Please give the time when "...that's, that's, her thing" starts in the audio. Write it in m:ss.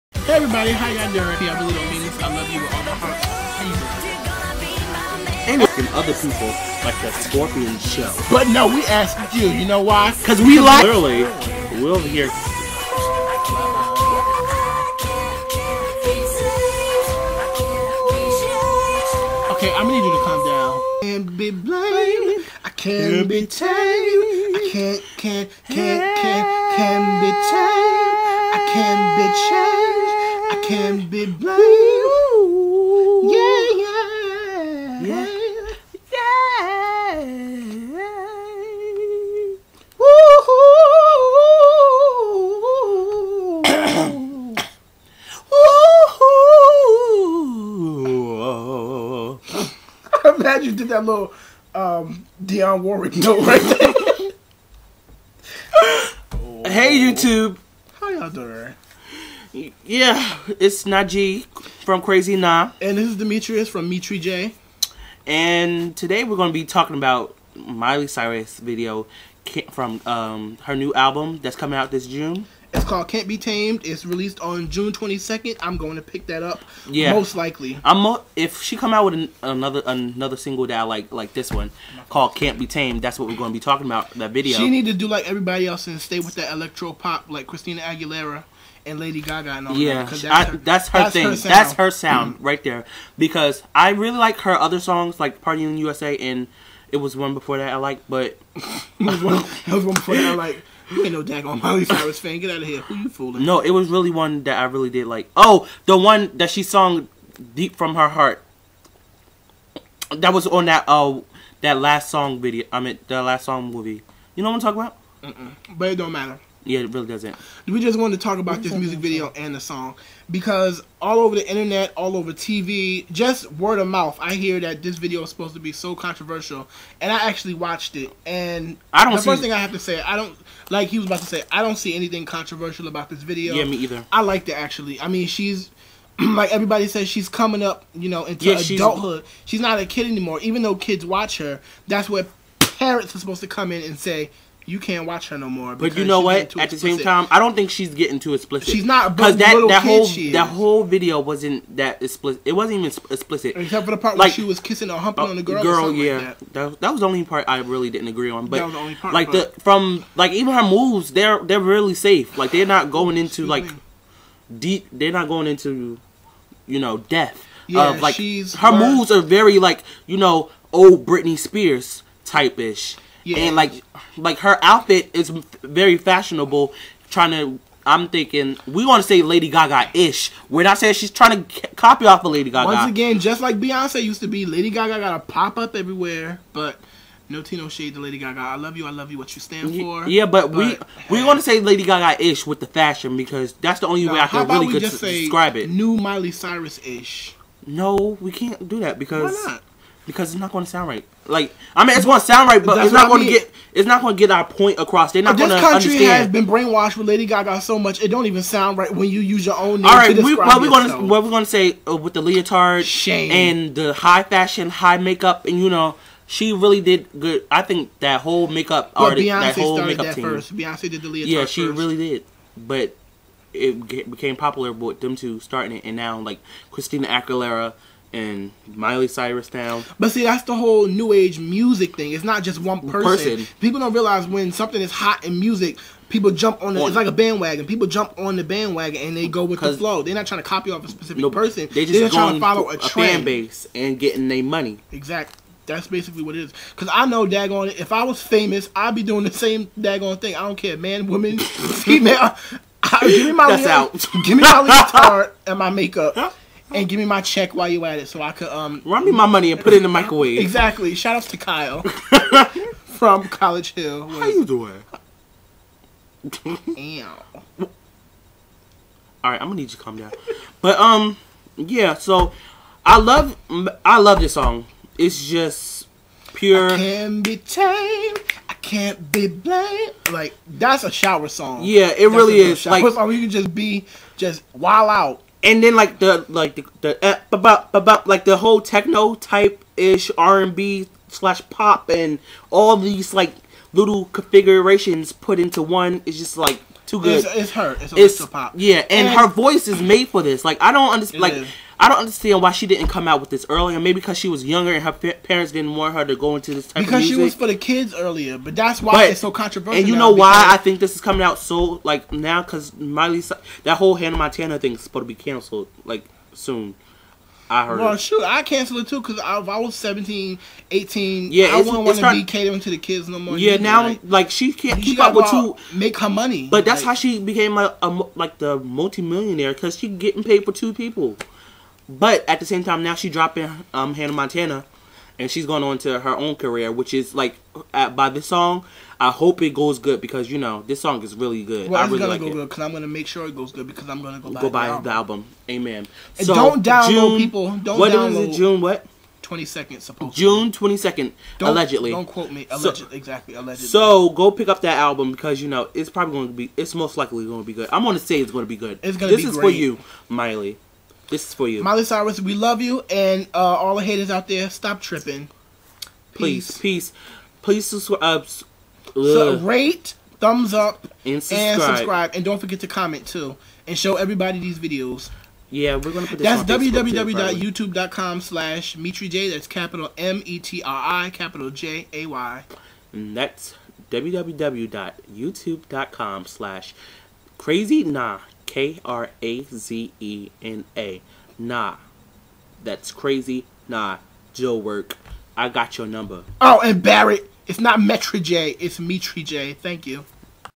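1:30.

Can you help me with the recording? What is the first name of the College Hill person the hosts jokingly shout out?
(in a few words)
Kyle.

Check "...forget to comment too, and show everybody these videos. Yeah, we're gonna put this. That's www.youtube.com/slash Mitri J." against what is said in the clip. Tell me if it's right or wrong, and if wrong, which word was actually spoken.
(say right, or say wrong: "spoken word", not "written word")
right.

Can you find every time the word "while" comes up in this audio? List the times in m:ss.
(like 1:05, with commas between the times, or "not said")
4:17.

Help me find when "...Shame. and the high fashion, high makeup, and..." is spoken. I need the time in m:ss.
3:32.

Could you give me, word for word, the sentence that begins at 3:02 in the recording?
Once again, just like Beyonce used to be, Lady Gaga got to pop up everywhere, but.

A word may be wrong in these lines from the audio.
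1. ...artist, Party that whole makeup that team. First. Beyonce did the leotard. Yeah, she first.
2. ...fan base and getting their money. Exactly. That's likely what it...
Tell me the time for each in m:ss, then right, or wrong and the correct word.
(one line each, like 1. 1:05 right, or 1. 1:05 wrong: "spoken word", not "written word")
1. 3:39 wrong: "Beyonce", not "Party"
2. 4:02 wrong: "basically", not "likely".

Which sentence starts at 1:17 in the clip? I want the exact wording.
I'm mo- if she come out with an, another another single that I like like this one called Can't Be Tamed.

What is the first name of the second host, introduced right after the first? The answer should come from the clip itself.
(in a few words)
Demetrius.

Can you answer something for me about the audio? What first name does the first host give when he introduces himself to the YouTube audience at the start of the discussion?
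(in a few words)
Najee.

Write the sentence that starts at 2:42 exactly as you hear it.
Like they're not going into like deep.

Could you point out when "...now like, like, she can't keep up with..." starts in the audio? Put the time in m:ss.
5:23.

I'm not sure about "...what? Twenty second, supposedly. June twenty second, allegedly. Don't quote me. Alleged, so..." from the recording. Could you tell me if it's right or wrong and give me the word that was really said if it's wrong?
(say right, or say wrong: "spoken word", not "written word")
right.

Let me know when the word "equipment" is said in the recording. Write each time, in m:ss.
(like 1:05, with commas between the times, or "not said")
not said.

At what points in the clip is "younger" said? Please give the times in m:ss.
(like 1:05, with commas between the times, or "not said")
5:04.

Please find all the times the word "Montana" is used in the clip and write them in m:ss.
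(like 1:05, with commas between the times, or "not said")
5:14, 5:34.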